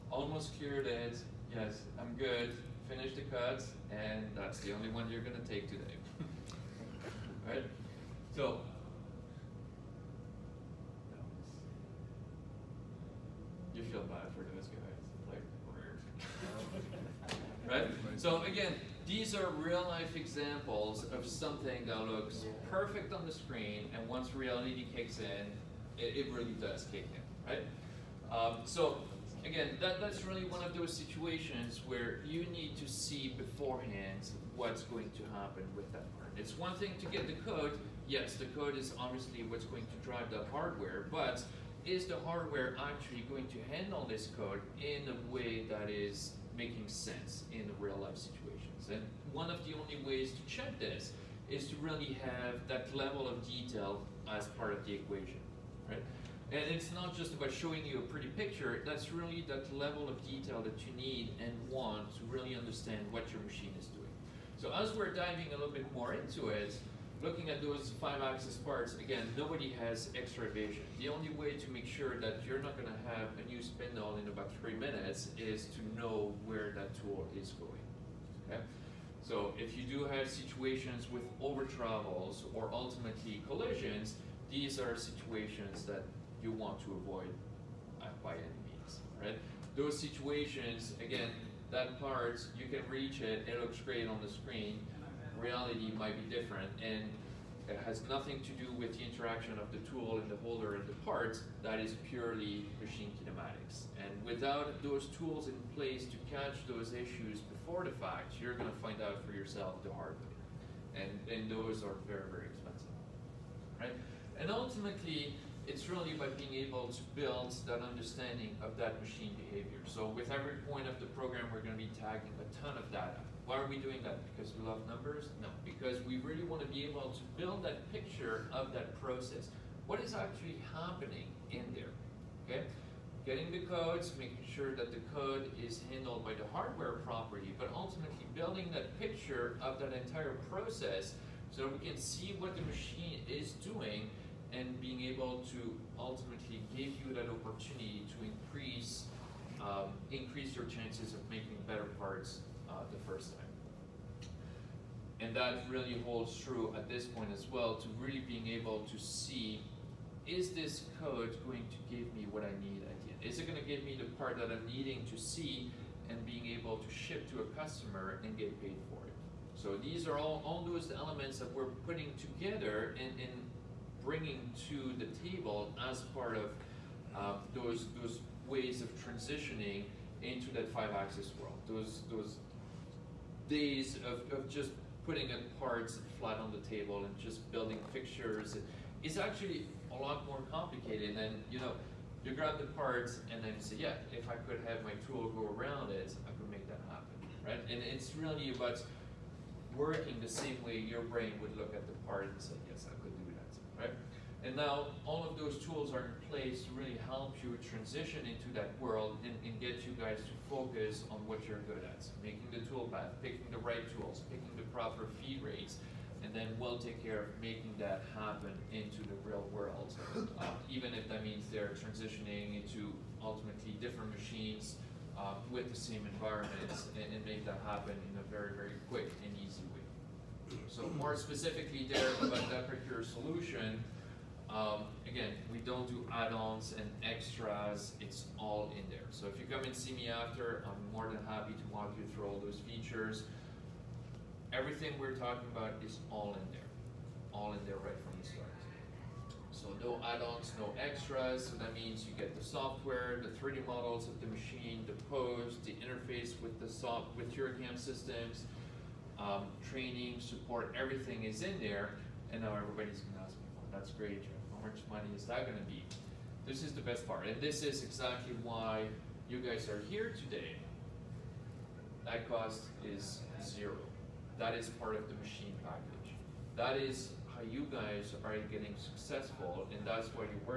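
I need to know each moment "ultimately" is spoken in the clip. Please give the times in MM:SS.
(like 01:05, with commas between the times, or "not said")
01:22, 01:54, 02:17, 02:25, 03:43.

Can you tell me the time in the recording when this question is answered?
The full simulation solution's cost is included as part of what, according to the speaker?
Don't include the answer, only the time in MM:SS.
04:35.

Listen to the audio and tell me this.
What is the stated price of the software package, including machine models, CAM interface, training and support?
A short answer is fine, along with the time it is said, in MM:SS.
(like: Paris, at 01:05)
zero, at 04:33.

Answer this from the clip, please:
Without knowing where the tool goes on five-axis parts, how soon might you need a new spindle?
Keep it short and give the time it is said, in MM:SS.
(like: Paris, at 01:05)
about 3 minutes, at 01:14.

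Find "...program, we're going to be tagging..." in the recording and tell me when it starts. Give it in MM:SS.
02:01.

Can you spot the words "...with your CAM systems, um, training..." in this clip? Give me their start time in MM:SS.
04:17.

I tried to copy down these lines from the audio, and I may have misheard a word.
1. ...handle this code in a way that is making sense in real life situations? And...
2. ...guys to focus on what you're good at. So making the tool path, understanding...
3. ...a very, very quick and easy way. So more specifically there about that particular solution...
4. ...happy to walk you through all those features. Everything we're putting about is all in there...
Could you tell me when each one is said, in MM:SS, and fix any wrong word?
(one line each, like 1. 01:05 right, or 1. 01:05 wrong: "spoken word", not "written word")
1. 00:43 right
2. 03:29 wrong: "picking", not "understanding"
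3. 03:48 right
4. 04:01 wrong: "talking", not "putting".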